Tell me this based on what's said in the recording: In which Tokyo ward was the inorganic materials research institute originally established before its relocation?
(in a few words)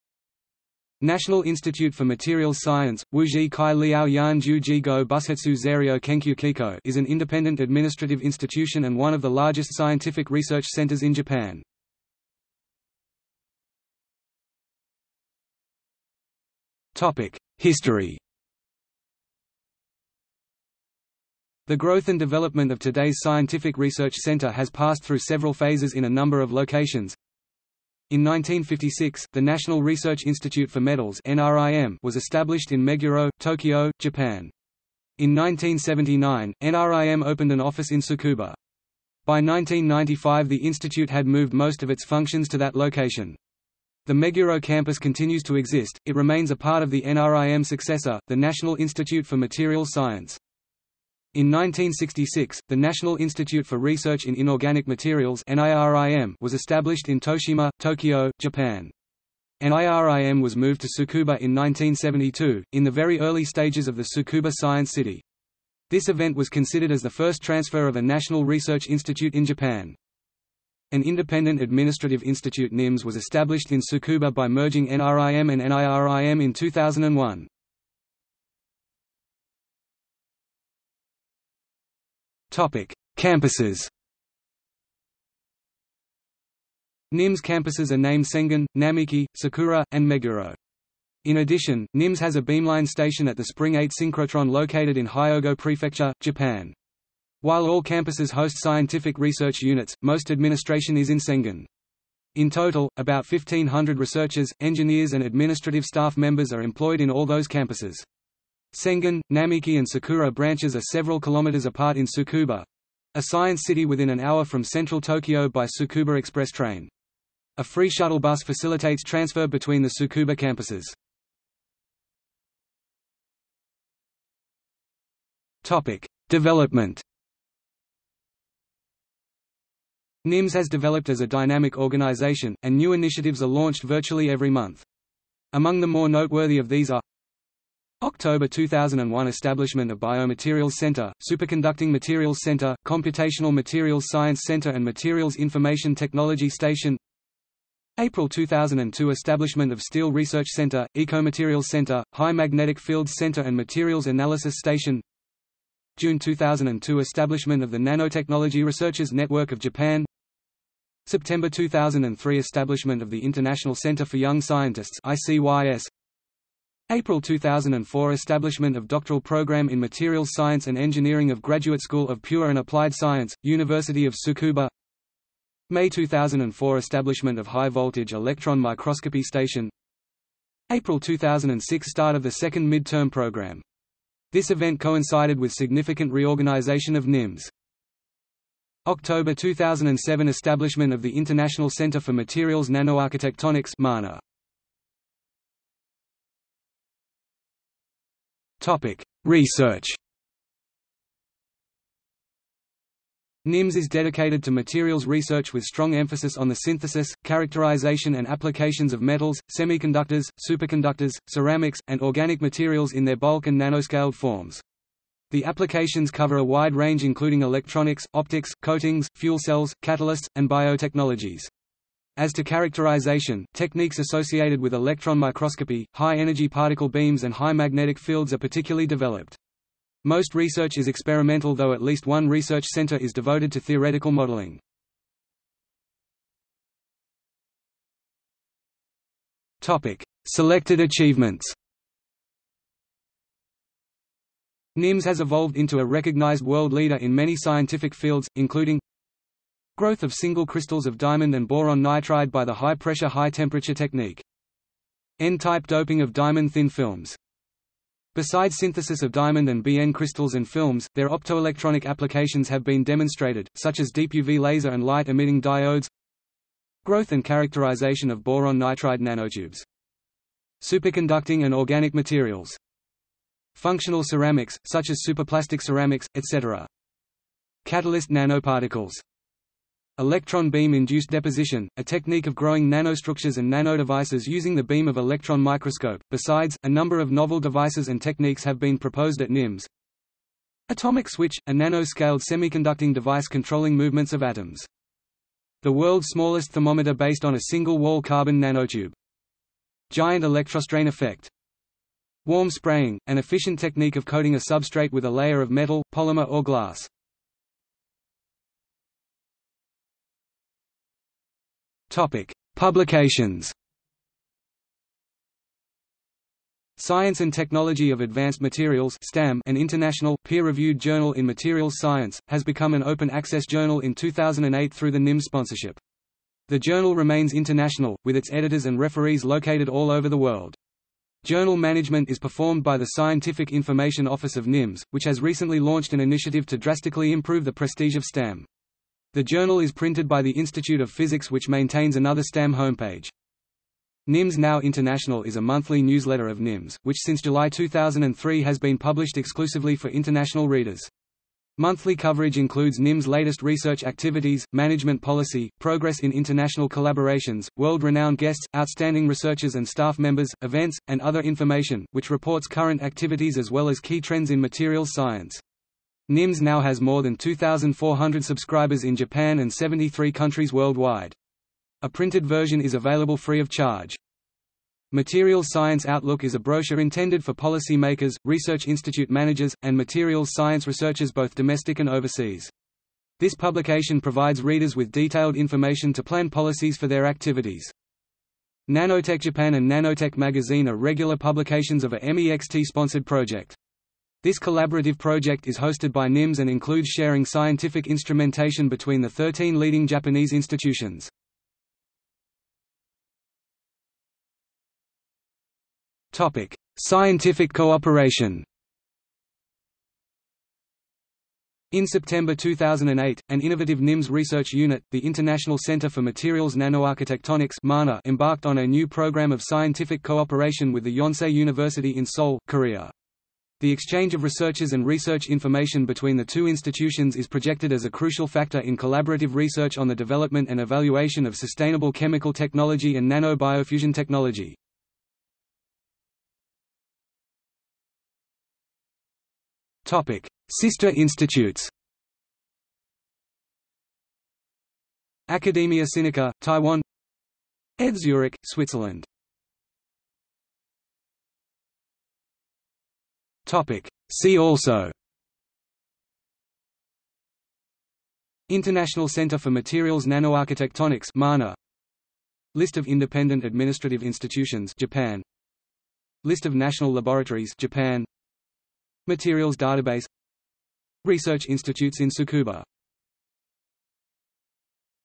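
Toshima.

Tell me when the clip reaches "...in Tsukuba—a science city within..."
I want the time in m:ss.
1:51.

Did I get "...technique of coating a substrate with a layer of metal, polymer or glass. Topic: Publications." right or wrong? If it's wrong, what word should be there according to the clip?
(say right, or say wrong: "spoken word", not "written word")
right.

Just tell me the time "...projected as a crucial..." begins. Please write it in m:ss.
7:07.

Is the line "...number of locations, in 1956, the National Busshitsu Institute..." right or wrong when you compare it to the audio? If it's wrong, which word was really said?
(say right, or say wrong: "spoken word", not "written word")
wrong: "Research", not "Busshitsu".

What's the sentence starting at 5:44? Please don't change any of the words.
NIMS Now International is a monthly newsletter of NIMS, which since July 2003 has been published exclusively for international readers.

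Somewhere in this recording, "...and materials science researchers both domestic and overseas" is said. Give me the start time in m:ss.
6:19.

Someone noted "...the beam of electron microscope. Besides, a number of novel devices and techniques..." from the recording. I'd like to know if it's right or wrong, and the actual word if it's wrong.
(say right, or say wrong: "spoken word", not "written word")
right.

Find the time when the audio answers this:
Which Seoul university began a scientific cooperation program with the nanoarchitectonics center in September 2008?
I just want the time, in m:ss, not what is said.
7:00.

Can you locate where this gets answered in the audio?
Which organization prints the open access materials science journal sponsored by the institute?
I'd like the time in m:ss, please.
5:40.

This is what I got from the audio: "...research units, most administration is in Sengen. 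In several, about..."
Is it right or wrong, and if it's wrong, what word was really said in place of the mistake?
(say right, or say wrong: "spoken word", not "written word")
wrong: "total", not "several".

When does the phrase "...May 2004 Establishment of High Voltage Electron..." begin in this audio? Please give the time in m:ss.
2:55.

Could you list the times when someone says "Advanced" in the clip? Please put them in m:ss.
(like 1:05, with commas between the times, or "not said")
5:17.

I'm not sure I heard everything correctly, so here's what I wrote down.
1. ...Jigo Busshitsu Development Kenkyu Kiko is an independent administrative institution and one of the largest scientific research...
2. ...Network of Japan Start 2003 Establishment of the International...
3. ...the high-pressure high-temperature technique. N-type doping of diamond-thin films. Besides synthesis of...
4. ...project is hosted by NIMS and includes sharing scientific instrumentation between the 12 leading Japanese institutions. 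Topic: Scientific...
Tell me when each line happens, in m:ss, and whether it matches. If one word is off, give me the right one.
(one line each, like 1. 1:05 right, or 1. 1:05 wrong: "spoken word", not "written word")
1. 0:04 wrong: "Zairyo", not "Development"
2. 2:39 wrong: "September", not "Start"
3. 4:12 right
4. 6:34 wrong: "13", not "12".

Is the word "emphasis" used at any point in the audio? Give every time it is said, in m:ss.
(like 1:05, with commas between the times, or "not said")
3:25.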